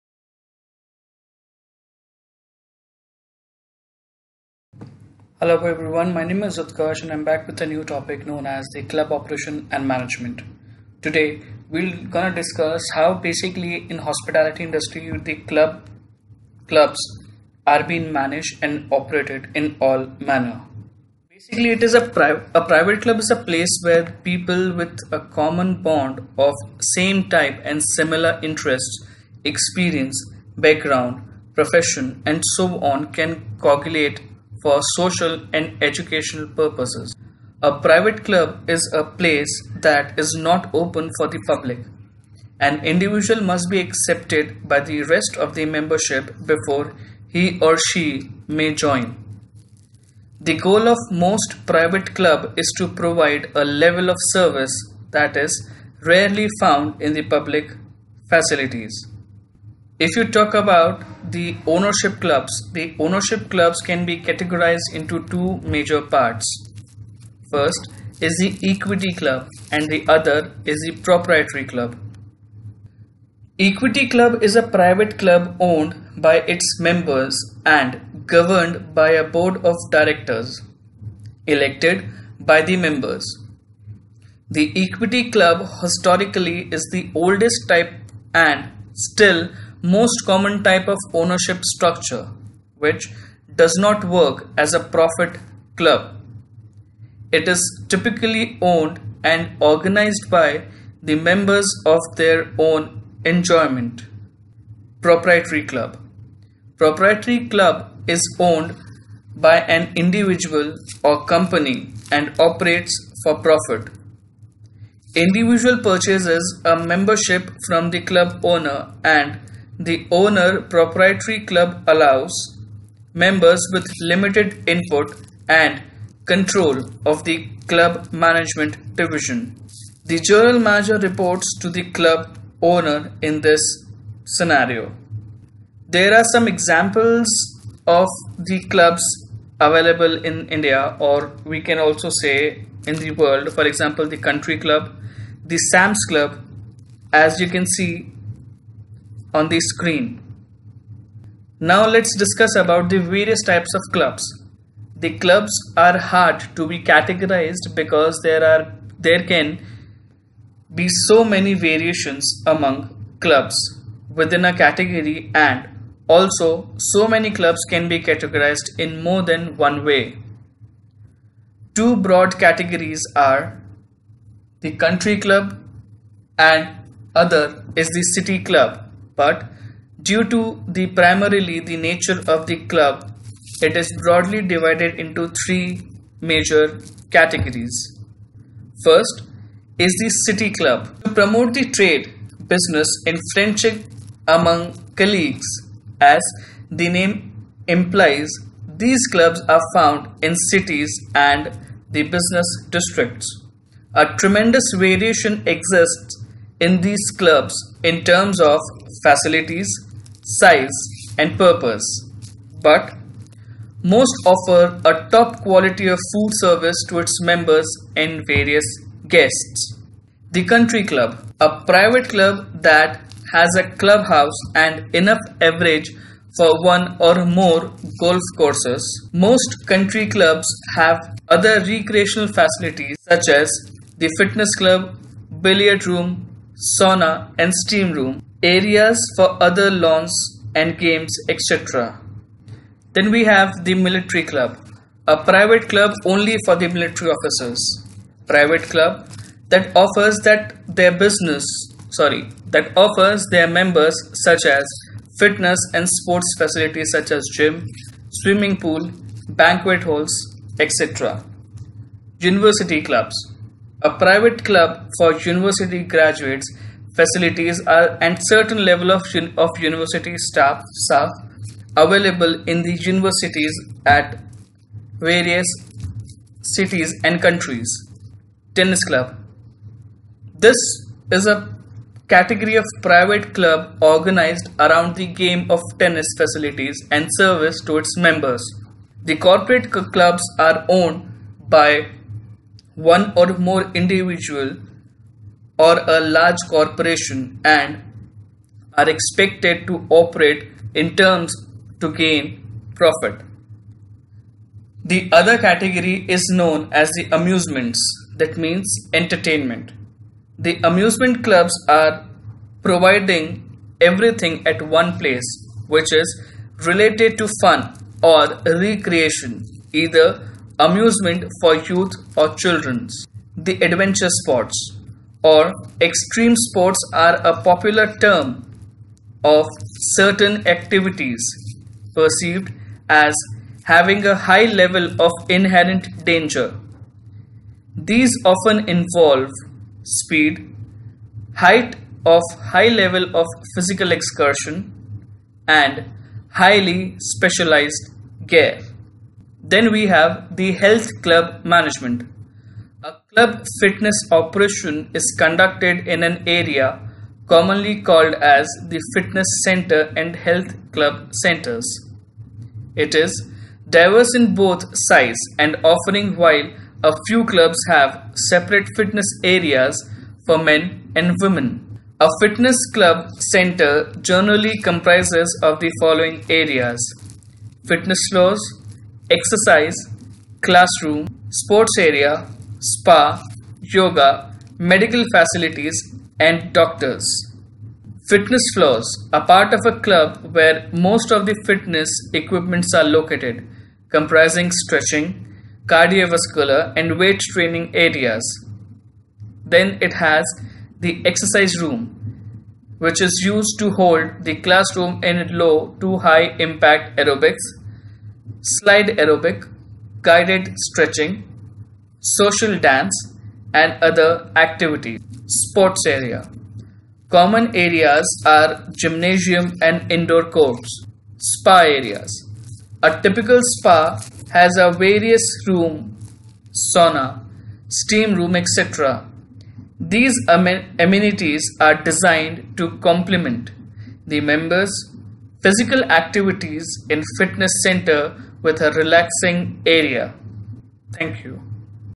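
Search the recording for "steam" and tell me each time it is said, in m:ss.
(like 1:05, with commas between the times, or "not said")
3:57, 7:07.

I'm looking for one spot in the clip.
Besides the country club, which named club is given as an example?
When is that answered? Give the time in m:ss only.
2:25.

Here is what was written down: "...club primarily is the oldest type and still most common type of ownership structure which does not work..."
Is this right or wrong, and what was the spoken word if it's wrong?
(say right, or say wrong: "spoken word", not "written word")
wrong: "historically", not "primarily".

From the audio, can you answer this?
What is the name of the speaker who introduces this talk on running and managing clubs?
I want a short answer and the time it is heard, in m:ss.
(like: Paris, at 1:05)
Utkarsh, at 0:06.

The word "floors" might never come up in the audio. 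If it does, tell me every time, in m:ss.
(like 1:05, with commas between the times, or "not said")
6:18, 6:28.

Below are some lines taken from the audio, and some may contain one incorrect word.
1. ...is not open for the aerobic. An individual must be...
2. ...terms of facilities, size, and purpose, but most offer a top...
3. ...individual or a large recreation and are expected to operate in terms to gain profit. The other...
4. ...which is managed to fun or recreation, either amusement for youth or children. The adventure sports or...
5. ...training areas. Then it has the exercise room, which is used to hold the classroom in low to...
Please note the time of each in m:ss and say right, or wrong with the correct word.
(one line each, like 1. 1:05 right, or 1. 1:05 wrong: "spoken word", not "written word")
1. 0:40 wrong: "public", not "aerobic"
2. 3:28 right
3. 4:53 wrong: "corporation", not "recreation"
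4. 5:15 wrong: "related", not "managed"
5. 6:37 right.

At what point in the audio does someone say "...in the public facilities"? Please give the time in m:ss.
0:57.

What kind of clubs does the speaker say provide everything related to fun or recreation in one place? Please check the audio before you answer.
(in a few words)
Amusement clubs.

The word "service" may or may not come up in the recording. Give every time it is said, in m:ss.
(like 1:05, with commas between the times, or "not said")
0:54, 3:36, 4:47.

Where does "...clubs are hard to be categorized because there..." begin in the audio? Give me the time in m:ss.
2:35.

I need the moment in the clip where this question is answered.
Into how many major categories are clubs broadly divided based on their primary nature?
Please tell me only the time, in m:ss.
3:05.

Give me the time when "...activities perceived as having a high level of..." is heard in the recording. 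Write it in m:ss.
5:30.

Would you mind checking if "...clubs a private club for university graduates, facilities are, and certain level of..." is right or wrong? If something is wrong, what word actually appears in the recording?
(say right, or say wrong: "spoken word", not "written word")
right.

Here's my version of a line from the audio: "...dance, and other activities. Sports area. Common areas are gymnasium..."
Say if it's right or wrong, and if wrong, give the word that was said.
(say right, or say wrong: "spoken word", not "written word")
right.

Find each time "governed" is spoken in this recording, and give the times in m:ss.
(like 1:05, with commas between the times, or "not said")
1:18.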